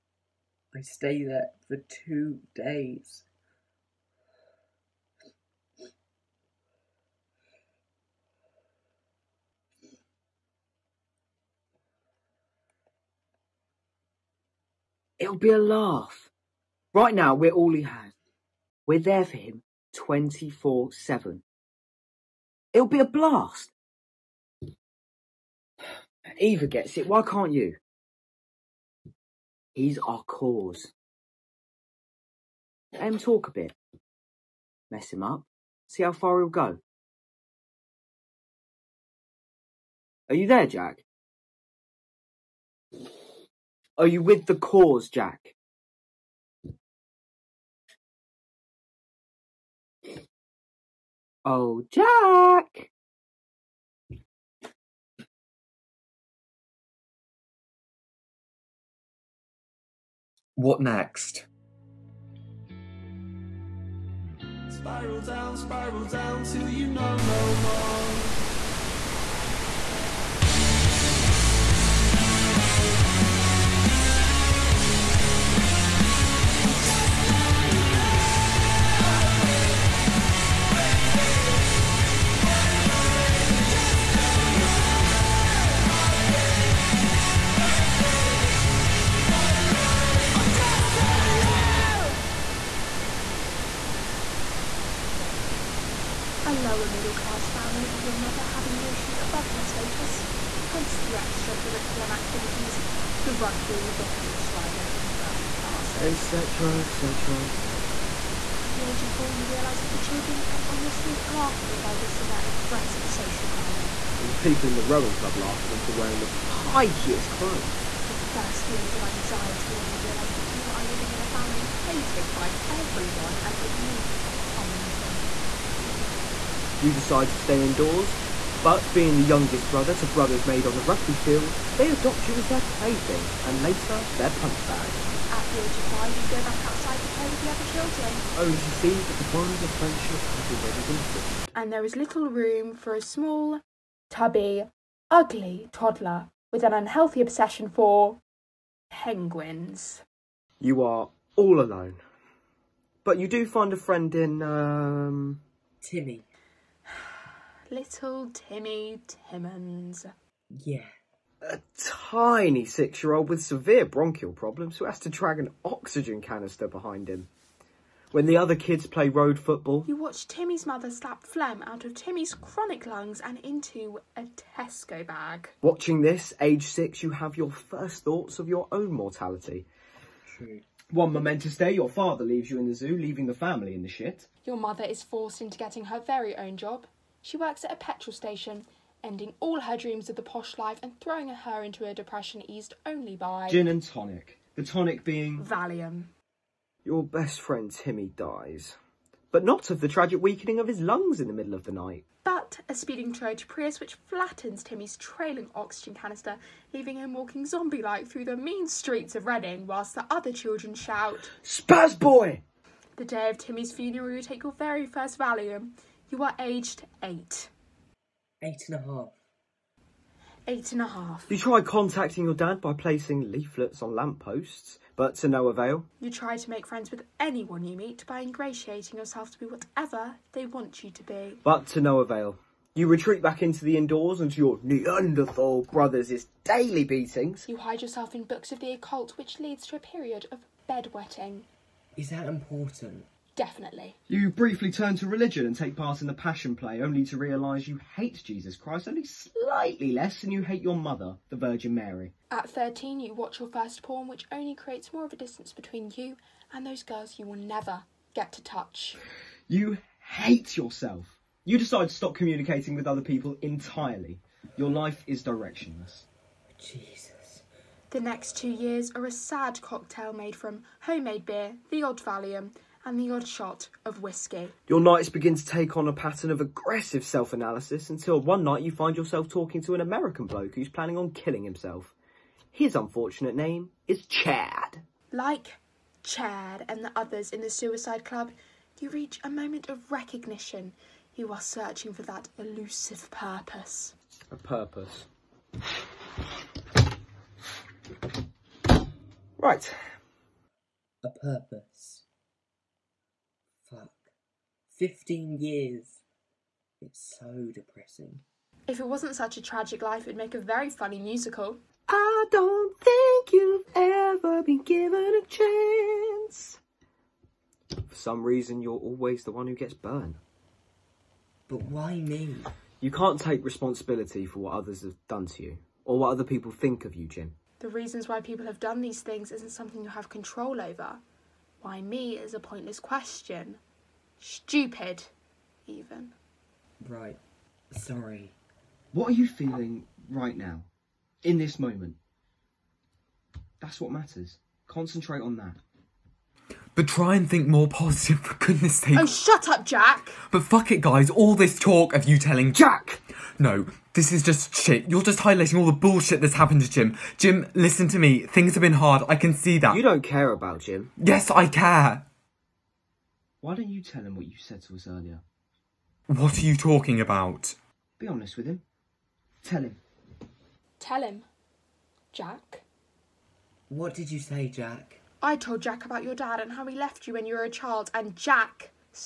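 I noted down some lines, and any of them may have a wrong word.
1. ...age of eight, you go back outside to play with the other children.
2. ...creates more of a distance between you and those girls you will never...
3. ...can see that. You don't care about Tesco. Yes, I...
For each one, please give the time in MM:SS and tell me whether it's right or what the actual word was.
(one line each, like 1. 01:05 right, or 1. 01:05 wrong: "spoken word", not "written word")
1. 02:15 wrong: "five", not "eight"
2. 04:14 right
3. 05:59 wrong: "Jim", not "Tesco".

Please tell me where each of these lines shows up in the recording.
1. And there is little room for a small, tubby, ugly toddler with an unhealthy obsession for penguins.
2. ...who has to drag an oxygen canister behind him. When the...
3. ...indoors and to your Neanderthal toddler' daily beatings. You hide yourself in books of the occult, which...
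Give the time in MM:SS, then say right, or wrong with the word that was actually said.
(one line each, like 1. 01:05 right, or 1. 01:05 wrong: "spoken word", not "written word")
1. 02:21 right
2. 02:44 right
3. 03:53 wrong: "brothers", not "toddler".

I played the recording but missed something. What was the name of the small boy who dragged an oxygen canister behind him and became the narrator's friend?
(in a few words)
Timmy Timmons.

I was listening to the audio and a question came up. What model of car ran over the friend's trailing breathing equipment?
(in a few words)
Toyota Prius.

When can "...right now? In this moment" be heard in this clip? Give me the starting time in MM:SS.
05:40.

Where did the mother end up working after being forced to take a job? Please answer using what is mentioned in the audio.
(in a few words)
a petrol station.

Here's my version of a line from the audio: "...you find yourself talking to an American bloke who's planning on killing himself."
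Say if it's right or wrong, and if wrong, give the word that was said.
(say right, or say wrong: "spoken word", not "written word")
right.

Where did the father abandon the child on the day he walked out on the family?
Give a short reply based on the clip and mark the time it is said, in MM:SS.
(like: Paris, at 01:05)
the zoo, at 03:02.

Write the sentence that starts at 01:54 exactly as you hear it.
And the people in the rowing club laugh at them for wearing the pikiest clothes.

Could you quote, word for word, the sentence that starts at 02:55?
Watching this, age six, you have your first thoughts of your own mortality.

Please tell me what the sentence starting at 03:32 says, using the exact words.
The day of Timmy's funeral, you take your very first Valium.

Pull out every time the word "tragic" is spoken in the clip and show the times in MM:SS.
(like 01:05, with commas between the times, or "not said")
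03:19, 05:09.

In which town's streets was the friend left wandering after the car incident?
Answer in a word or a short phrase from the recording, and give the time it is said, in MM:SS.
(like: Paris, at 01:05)
Reading, at 03:29.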